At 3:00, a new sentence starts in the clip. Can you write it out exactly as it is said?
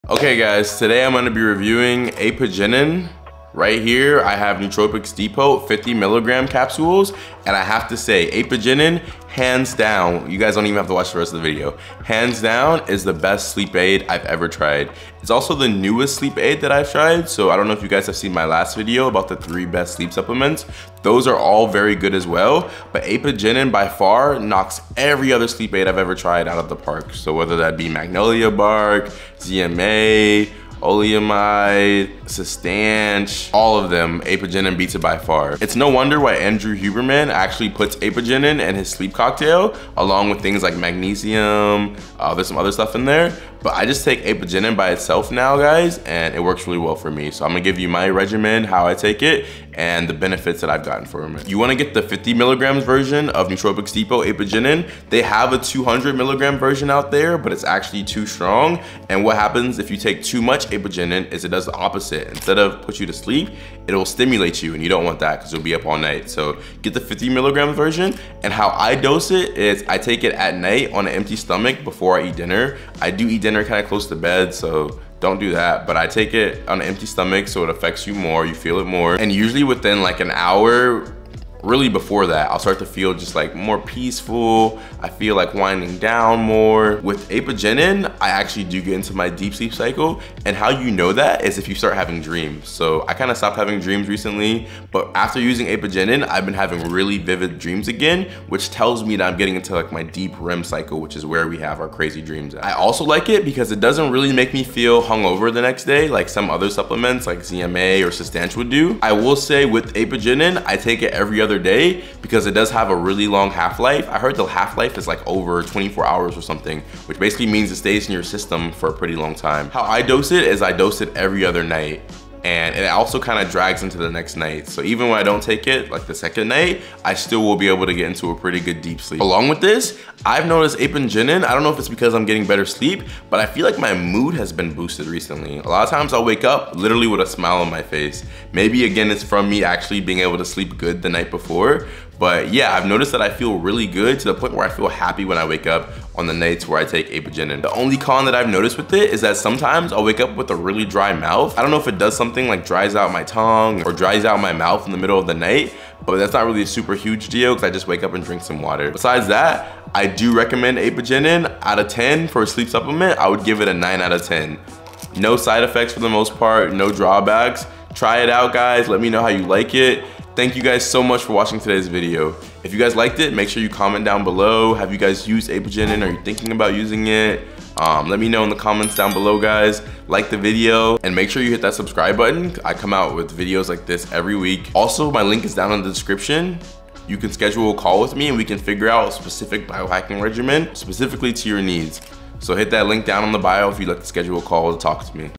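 Like the video and make sure you hit that subscribe button.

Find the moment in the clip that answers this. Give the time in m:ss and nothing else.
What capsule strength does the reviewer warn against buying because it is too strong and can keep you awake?
0:55.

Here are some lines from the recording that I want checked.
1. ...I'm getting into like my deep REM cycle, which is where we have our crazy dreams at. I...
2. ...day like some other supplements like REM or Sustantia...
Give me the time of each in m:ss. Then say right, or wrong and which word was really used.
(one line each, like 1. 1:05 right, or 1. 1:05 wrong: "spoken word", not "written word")
1. 1:39 right
2. 1:45 wrong: "ZMA", not "REM".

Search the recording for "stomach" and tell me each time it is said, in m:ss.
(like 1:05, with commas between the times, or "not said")
1:11, 1:17.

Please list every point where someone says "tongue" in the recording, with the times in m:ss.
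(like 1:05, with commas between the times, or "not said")
2:33.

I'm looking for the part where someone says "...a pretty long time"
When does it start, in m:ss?
1:58.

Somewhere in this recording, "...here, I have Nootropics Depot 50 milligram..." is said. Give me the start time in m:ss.
0:03.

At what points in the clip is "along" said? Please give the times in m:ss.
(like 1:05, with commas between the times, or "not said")
0:39, 2:09.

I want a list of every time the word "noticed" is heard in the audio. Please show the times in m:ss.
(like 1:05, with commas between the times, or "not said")
2:10, 2:22, 2:28.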